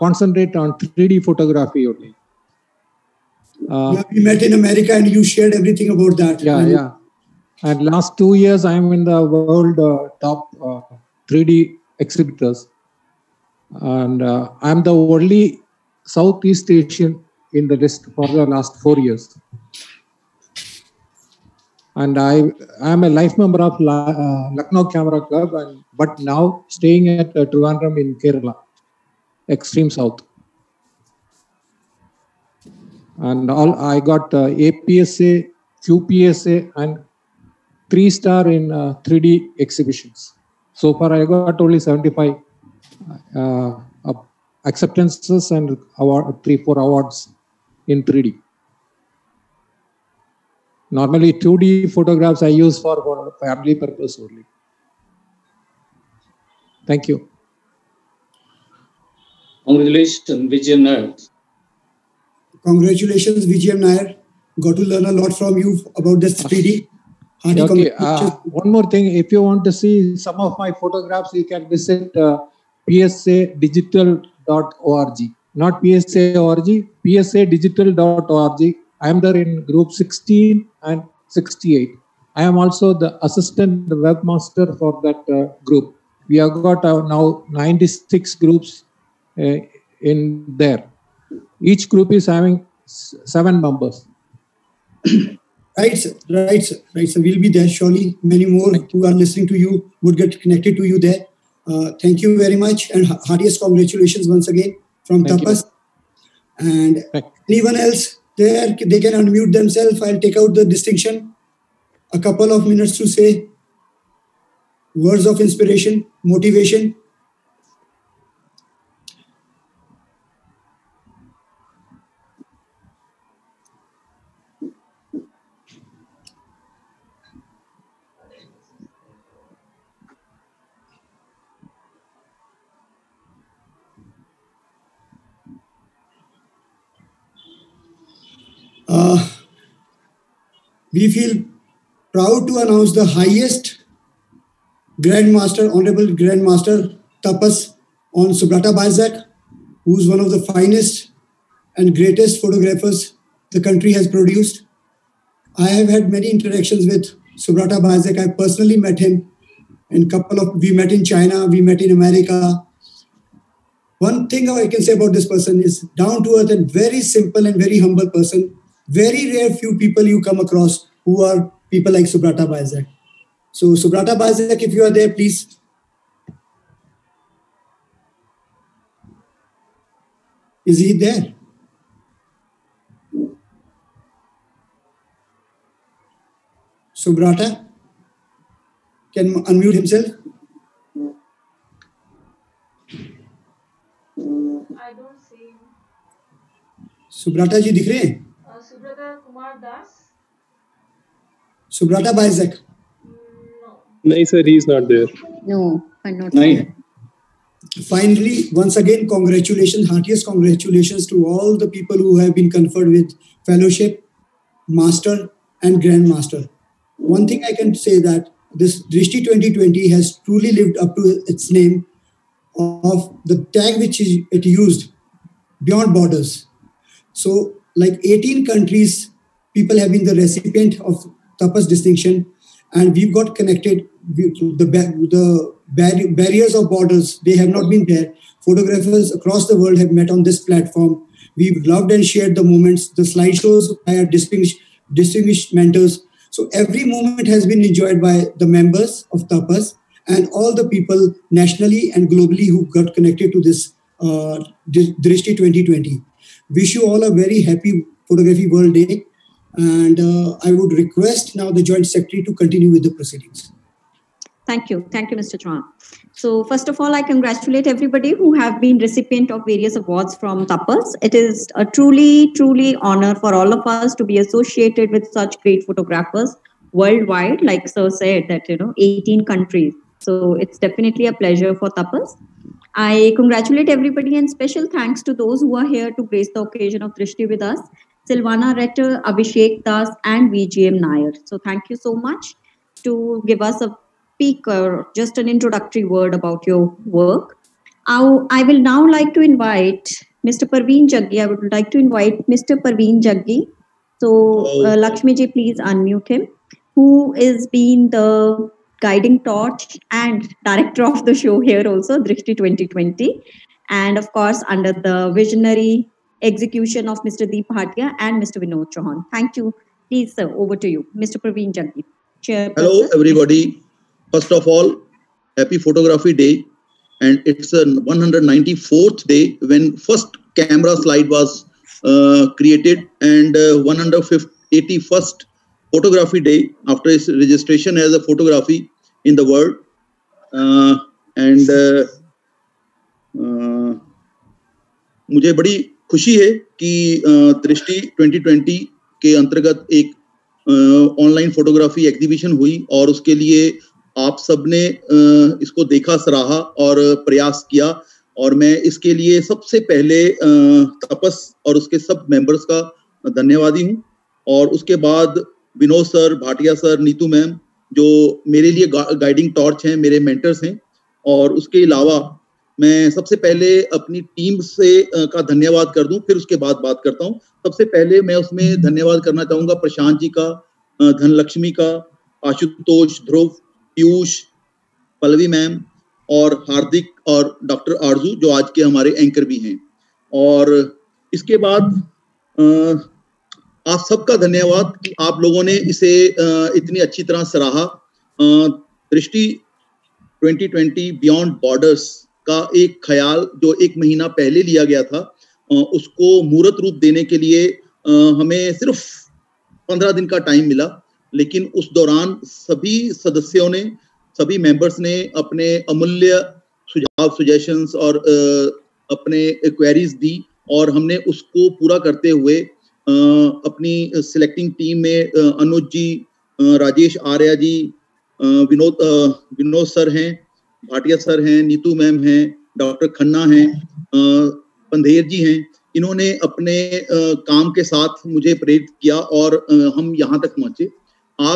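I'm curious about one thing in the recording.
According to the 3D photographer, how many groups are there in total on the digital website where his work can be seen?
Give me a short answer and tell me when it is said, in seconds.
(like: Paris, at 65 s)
96, at 87 s.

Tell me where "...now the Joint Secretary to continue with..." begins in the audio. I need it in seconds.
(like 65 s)
261 s.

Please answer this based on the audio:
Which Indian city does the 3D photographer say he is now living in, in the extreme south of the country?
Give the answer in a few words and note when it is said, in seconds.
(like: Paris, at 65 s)
Trivandrum, at 27 s.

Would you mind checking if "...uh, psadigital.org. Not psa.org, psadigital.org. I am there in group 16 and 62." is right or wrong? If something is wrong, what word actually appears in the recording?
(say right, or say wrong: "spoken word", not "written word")
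wrong: "68", not "62".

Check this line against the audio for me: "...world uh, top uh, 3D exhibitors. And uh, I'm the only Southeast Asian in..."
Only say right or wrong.
right.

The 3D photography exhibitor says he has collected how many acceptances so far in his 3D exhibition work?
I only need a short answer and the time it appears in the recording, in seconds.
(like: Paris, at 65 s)
75, at 41 s.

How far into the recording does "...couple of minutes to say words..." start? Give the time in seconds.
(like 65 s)
112 s.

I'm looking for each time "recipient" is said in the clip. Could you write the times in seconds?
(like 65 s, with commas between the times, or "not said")
230 s, 268 s.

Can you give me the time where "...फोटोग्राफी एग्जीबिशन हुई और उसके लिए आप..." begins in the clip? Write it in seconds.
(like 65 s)
351 s.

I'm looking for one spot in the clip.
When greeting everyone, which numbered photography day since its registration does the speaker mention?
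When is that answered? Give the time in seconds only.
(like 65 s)
333 s.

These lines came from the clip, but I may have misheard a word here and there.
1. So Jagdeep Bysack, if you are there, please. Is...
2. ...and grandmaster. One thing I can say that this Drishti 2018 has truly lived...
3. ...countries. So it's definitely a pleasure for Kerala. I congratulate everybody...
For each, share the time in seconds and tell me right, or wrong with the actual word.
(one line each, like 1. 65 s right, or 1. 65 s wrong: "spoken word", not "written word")
1. 173 s wrong: "Subrata", not "Jagdeep"
2. 215 s wrong: "2020", not "2018"
3. 279 s wrong: "TAPAS", not "Kerala".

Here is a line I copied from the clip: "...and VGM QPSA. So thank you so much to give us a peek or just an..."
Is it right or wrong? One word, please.
wrong.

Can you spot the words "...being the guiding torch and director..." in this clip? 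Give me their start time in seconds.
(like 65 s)
307 s.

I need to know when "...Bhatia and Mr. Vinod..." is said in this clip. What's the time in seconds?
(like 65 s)
317 s.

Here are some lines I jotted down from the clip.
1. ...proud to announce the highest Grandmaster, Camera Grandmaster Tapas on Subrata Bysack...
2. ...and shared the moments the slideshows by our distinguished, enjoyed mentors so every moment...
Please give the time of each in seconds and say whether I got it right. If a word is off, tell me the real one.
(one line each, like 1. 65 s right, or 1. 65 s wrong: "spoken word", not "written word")
1. 142 s wrong: "Honorable", not "Camera"
2. 241 s wrong: "distinguished", not "enjoyed".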